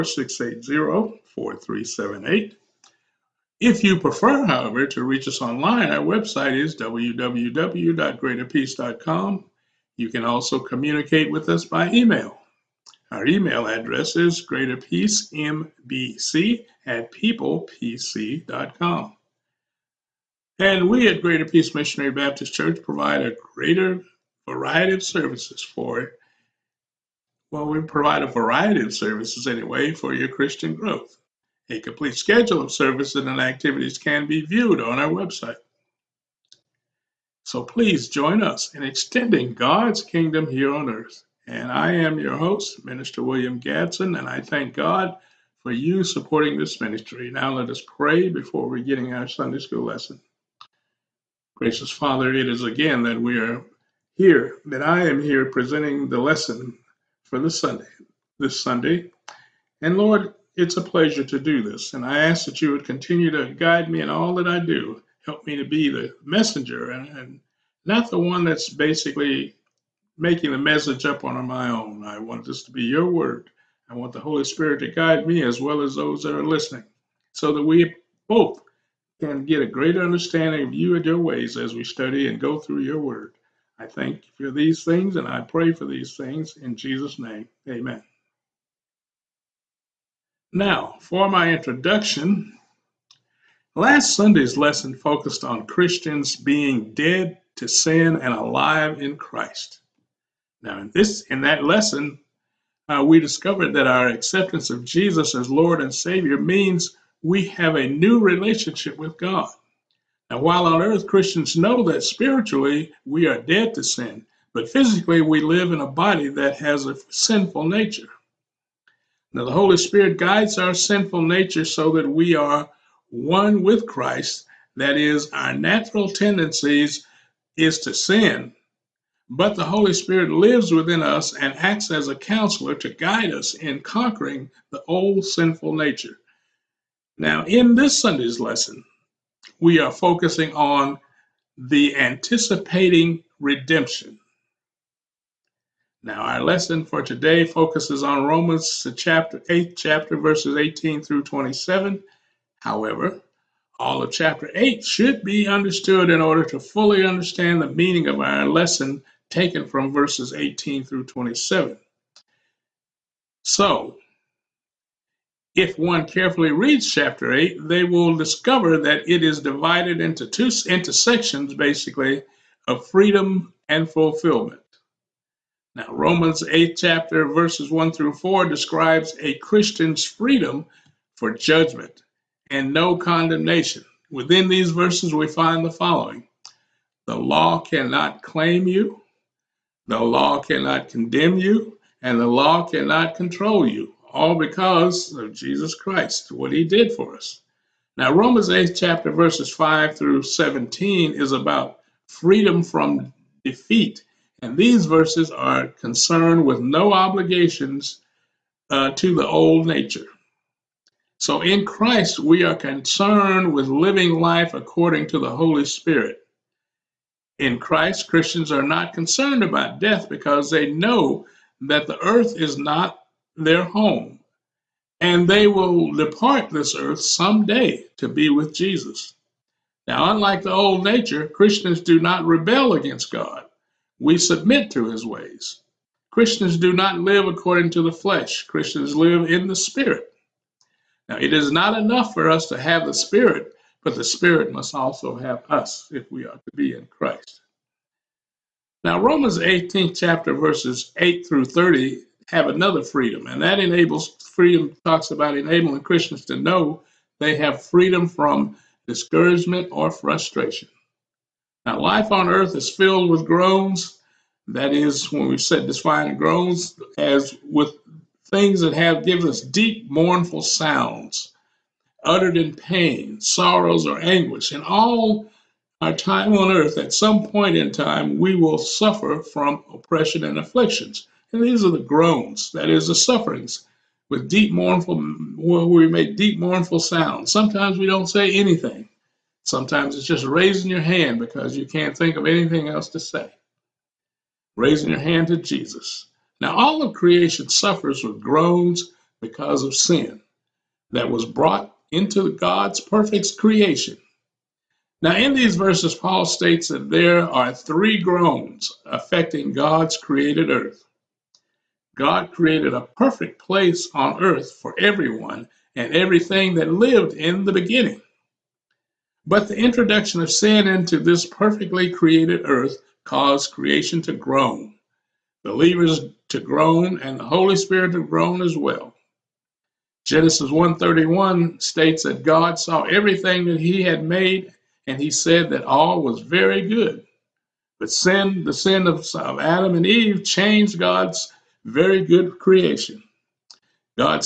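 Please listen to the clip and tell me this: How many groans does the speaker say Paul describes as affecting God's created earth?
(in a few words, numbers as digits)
3.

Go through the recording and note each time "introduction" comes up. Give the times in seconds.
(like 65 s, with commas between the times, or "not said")
91 s, 319 s.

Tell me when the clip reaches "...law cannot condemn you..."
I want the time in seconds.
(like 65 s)
190 s.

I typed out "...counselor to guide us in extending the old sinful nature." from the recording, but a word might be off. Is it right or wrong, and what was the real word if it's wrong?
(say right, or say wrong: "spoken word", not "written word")
wrong: "conquering", not "extending".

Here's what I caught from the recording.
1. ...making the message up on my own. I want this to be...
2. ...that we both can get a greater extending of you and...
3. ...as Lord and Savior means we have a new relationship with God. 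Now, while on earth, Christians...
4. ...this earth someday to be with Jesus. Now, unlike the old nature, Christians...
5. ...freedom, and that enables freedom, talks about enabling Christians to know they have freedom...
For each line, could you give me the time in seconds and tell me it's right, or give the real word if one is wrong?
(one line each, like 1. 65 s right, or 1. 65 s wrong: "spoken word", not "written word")
1. 70 s right
2. 77 s wrong: "understanding", not "extending"
3. 105 s right
4. 226 s right
5. 252 s right.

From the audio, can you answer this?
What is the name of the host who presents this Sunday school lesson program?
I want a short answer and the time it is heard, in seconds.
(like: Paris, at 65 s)
William Gadson, at 43 s.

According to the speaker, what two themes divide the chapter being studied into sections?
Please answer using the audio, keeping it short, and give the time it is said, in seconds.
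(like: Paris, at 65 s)
Freedom and fulfillment, at 172 s.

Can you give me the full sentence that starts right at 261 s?
Now, life on earth is filled with groans.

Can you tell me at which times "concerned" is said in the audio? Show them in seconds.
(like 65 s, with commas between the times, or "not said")
205 s, 212 s, 218 s.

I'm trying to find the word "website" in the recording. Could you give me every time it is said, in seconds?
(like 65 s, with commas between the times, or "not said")
6 s, 35 s.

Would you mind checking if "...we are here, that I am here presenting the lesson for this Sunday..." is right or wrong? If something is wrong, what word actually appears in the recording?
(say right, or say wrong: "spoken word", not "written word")
right.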